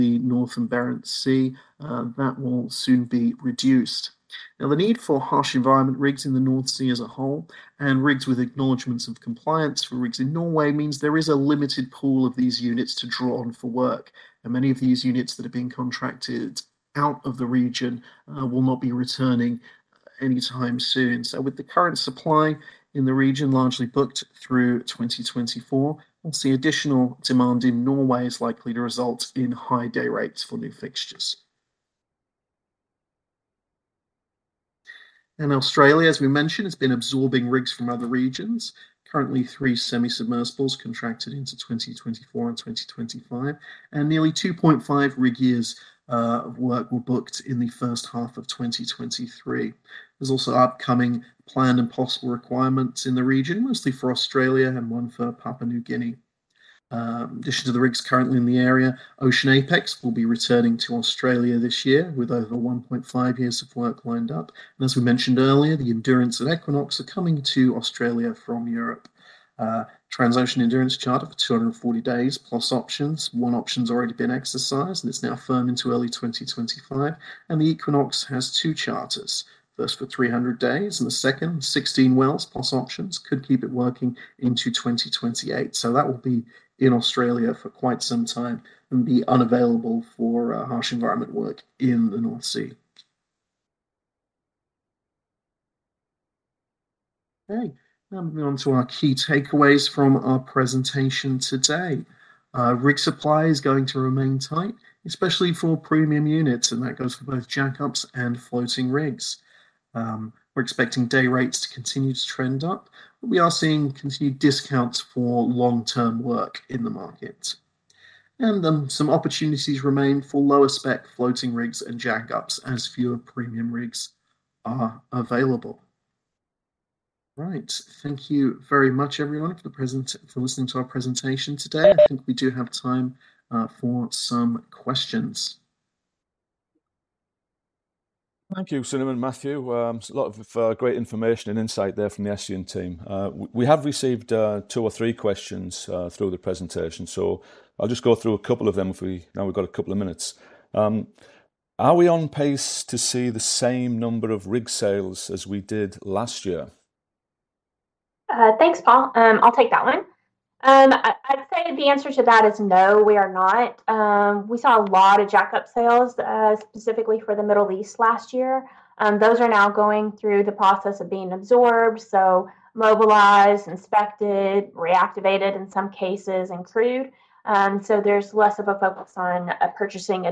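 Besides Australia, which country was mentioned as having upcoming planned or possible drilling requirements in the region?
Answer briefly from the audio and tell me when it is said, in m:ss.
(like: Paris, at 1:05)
Papua New Guinea, at 0:55.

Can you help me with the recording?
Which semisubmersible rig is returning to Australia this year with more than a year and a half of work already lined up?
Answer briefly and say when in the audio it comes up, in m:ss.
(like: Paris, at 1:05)
Ocean Apex, at 0:59.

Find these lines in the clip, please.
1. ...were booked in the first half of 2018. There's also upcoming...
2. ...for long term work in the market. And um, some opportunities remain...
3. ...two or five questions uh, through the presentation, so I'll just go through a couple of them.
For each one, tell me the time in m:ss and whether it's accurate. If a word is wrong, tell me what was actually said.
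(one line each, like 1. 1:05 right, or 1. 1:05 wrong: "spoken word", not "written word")
1. 0:46 wrong: "2023", not "2018"
2. 1:55 right
3. 2:24 wrong: "three", not "five".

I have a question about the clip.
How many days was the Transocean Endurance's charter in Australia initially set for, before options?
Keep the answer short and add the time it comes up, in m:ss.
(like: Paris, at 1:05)
240 days, at 1:11.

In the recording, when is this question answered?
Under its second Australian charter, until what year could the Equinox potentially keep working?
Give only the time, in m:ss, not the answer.
1:24.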